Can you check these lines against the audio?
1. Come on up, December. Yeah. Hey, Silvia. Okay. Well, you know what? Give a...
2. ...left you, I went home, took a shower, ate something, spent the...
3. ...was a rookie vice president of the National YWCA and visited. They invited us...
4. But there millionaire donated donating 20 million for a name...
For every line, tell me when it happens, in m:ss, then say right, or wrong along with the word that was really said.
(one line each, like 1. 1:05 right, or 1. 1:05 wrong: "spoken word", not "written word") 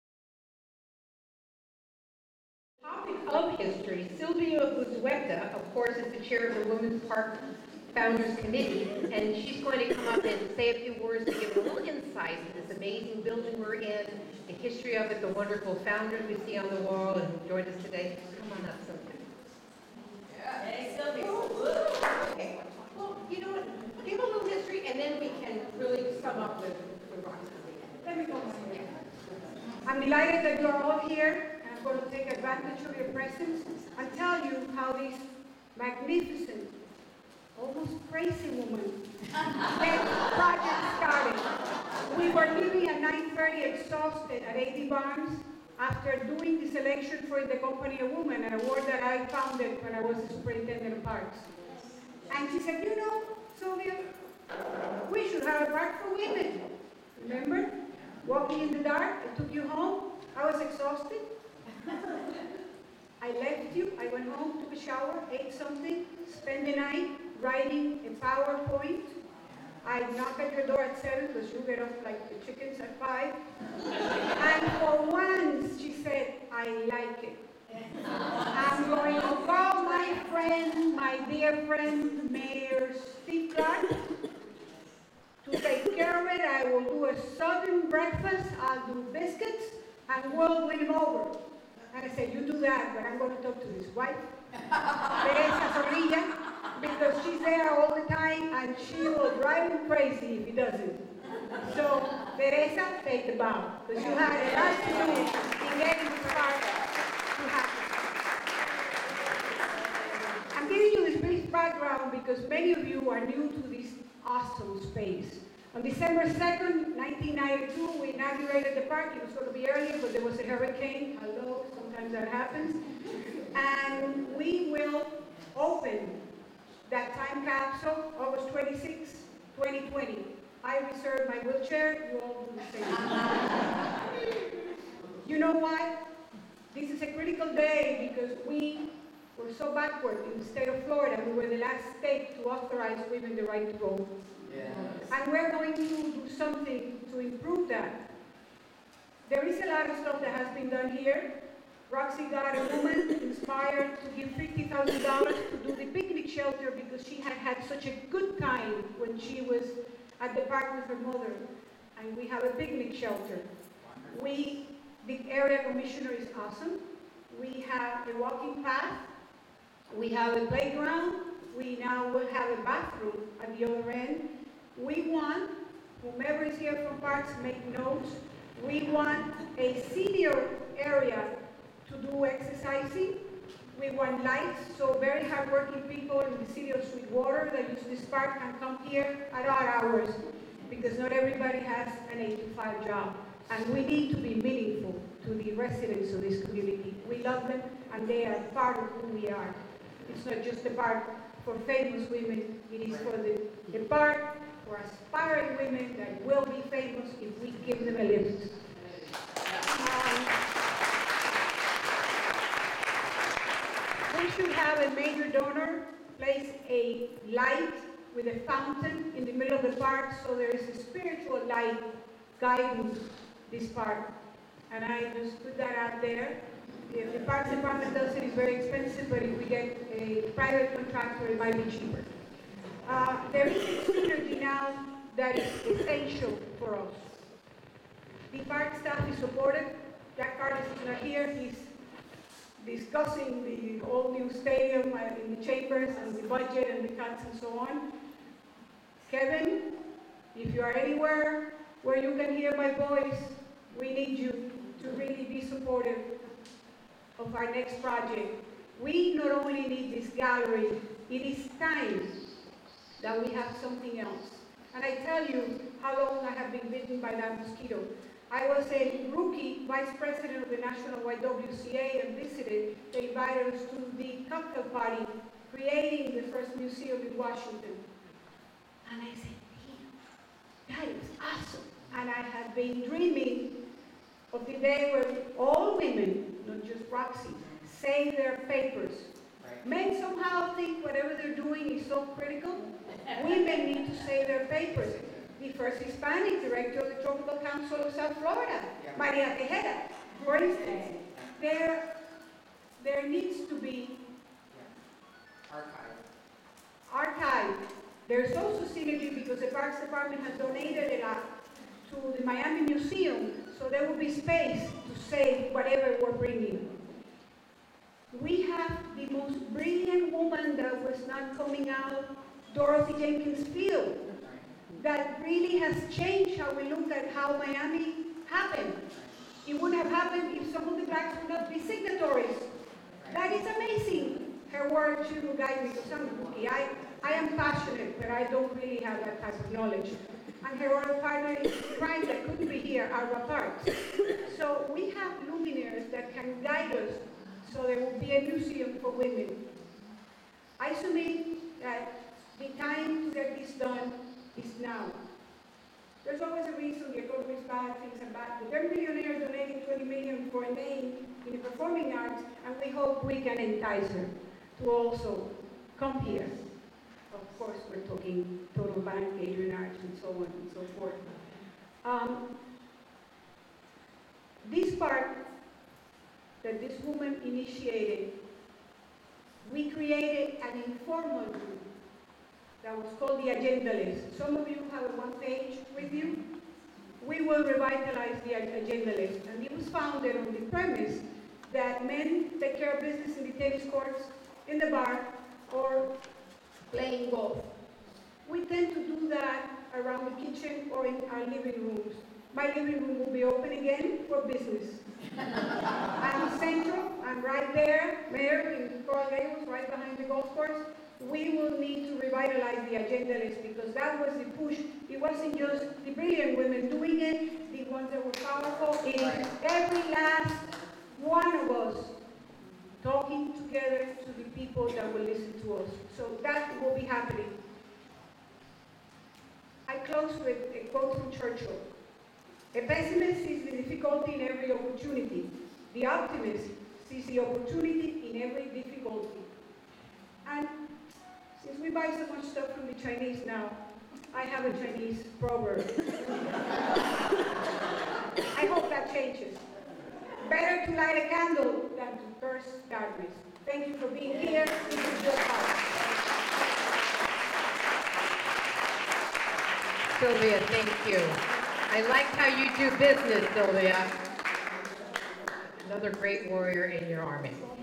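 1. 0:18 wrong: "Silvia", not "December"
2. 1:03 right
3. 4:28 right
4. 5:58 right.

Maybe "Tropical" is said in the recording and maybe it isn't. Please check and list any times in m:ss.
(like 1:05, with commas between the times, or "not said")
4:57.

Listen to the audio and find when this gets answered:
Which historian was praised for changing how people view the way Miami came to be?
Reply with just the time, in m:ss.
5:22.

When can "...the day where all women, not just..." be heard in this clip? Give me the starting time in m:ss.
4:44.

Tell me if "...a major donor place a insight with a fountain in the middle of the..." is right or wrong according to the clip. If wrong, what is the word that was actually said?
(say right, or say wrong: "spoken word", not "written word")
wrong: "light", not "insight".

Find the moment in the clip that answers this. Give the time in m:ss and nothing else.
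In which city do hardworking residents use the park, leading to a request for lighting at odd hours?
3:06.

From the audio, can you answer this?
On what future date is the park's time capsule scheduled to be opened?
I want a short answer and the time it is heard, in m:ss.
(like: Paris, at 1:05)
August 26, 2020, at 2:08.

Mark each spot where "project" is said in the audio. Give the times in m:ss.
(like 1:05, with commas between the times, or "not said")
0:40, 4:17.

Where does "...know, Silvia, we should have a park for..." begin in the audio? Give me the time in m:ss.
0:52.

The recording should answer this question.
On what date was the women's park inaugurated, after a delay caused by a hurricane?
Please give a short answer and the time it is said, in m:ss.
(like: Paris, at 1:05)
December 2, 1992, at 1:55.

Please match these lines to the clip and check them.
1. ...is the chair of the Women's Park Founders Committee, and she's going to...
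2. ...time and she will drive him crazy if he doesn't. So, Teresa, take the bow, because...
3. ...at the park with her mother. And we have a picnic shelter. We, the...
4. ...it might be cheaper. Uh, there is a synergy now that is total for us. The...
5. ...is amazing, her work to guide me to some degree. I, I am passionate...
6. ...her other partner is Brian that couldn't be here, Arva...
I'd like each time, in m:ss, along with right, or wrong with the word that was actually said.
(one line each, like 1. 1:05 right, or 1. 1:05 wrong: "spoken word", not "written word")
1. 0:05 right
2. 1:38 right
3. 2:40 right
4. 3:51 wrong: "essential", not "total"
5. 5:33 right
6. 5:40 right.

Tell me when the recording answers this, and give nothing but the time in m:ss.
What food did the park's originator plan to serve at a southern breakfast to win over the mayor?
1:29.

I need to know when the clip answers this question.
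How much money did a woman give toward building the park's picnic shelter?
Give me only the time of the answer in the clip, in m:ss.
2:34.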